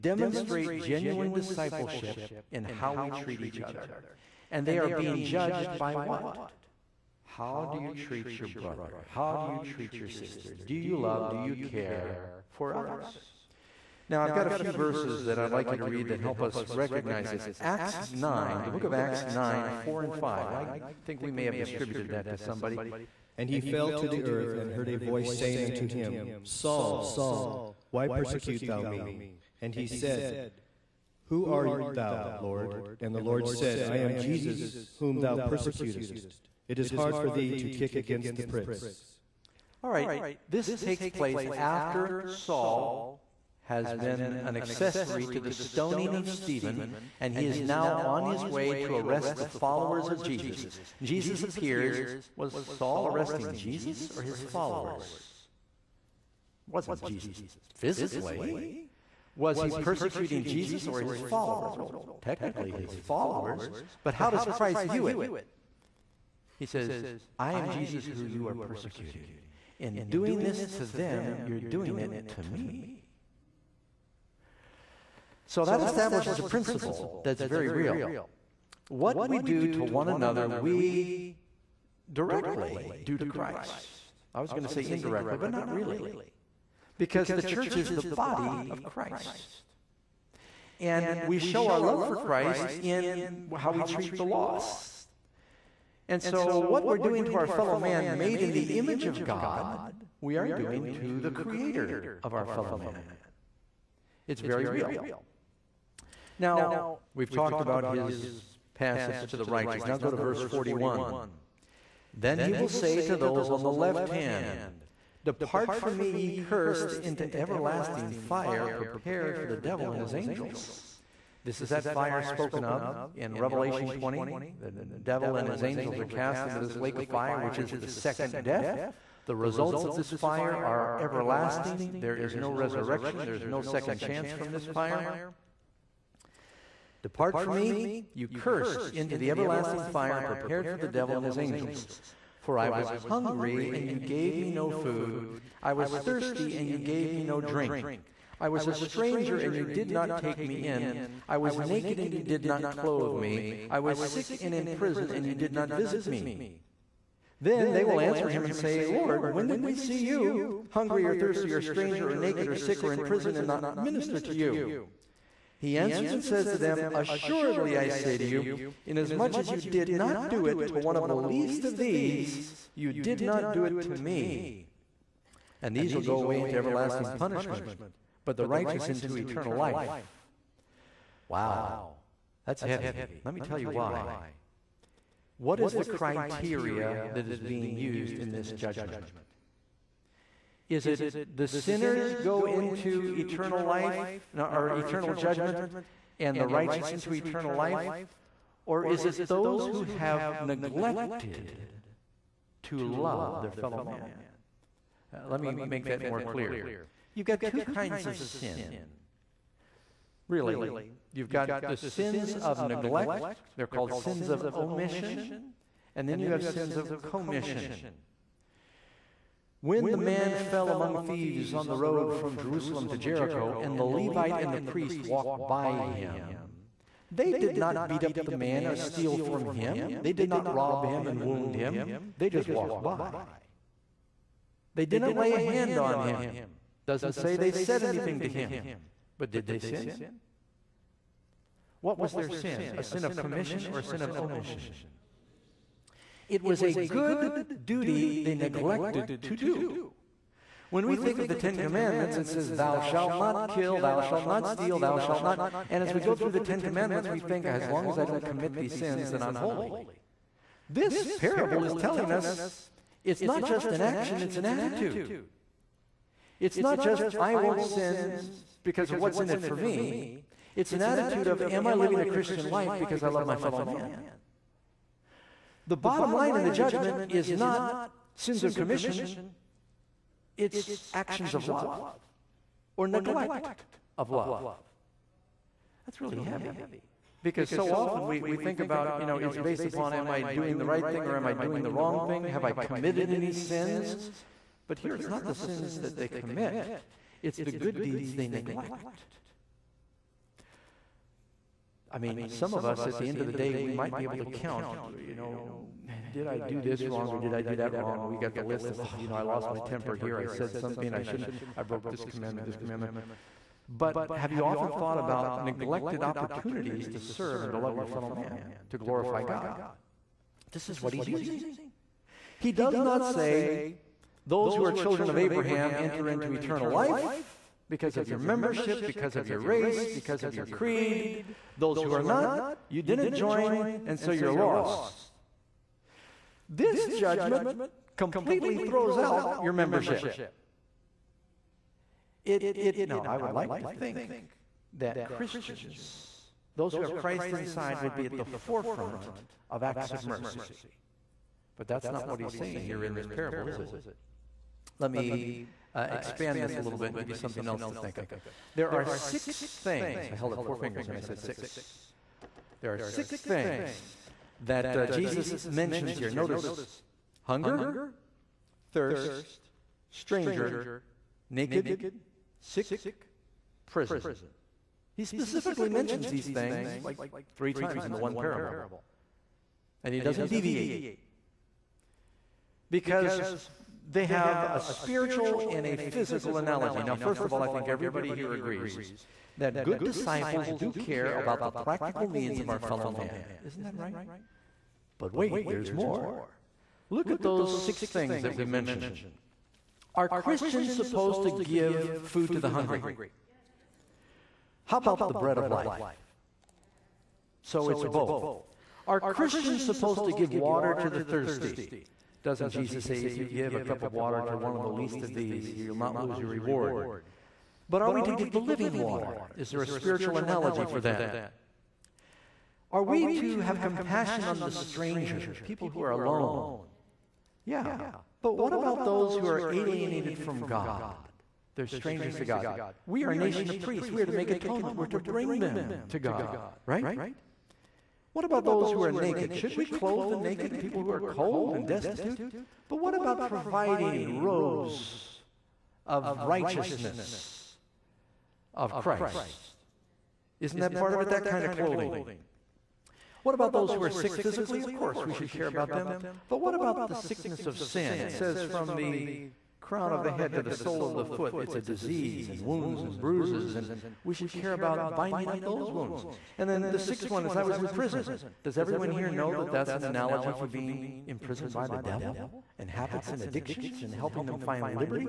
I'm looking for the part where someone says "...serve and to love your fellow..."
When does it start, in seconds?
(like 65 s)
316 s.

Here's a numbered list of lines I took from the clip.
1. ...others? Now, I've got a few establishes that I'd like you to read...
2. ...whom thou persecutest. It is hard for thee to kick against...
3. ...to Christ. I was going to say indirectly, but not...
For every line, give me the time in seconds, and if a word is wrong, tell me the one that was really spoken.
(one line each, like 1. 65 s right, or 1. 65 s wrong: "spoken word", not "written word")
1. 12 s wrong: "verses", not "establishes"
2. 34 s right
3. 83 s right.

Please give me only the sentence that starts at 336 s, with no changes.
This judgment completely throws out your membership.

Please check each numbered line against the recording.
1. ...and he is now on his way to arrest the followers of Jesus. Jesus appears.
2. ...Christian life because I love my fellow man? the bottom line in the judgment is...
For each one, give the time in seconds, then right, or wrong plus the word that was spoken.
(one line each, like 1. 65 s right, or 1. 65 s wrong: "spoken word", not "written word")
1. 47 s right
2. 272 s right.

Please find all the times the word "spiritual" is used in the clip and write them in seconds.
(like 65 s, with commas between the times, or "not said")
384 s, 419 s.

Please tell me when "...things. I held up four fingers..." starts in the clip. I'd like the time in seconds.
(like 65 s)
359 s.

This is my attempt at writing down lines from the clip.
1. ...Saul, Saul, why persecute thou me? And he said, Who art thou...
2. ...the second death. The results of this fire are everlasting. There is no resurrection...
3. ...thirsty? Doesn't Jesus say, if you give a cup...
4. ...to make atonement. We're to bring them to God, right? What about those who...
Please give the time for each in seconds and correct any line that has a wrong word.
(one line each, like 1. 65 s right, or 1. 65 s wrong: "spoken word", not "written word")
1. 26 s right
2. 127 s right
3. 410 s right
4. 434 s right.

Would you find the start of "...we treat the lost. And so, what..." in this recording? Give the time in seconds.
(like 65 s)
93 s.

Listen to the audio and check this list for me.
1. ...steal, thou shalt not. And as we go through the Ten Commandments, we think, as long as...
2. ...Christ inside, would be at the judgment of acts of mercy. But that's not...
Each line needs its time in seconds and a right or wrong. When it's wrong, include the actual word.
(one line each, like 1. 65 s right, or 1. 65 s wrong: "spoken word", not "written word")
1. 254 s right
2. 346 s wrong: "forefront", not "judgment".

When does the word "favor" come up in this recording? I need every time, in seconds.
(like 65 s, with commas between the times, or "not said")
not said.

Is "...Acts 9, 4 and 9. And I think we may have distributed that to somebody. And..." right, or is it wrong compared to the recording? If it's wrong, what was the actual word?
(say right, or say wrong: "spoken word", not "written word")
wrong: "5", not "9".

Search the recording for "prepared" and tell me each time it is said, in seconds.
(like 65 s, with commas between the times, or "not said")
118 s, 140 s.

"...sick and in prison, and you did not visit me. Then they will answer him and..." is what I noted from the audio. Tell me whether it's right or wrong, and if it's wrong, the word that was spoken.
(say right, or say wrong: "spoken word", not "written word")
right.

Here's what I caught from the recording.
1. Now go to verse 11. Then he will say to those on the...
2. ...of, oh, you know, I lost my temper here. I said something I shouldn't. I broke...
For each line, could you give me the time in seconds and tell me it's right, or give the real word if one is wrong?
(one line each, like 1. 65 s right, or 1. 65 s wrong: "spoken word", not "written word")
1. 109 s wrong: "41", not "11"
2. 308 s right.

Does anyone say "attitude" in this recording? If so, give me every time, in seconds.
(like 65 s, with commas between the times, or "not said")
264 s, 270 s.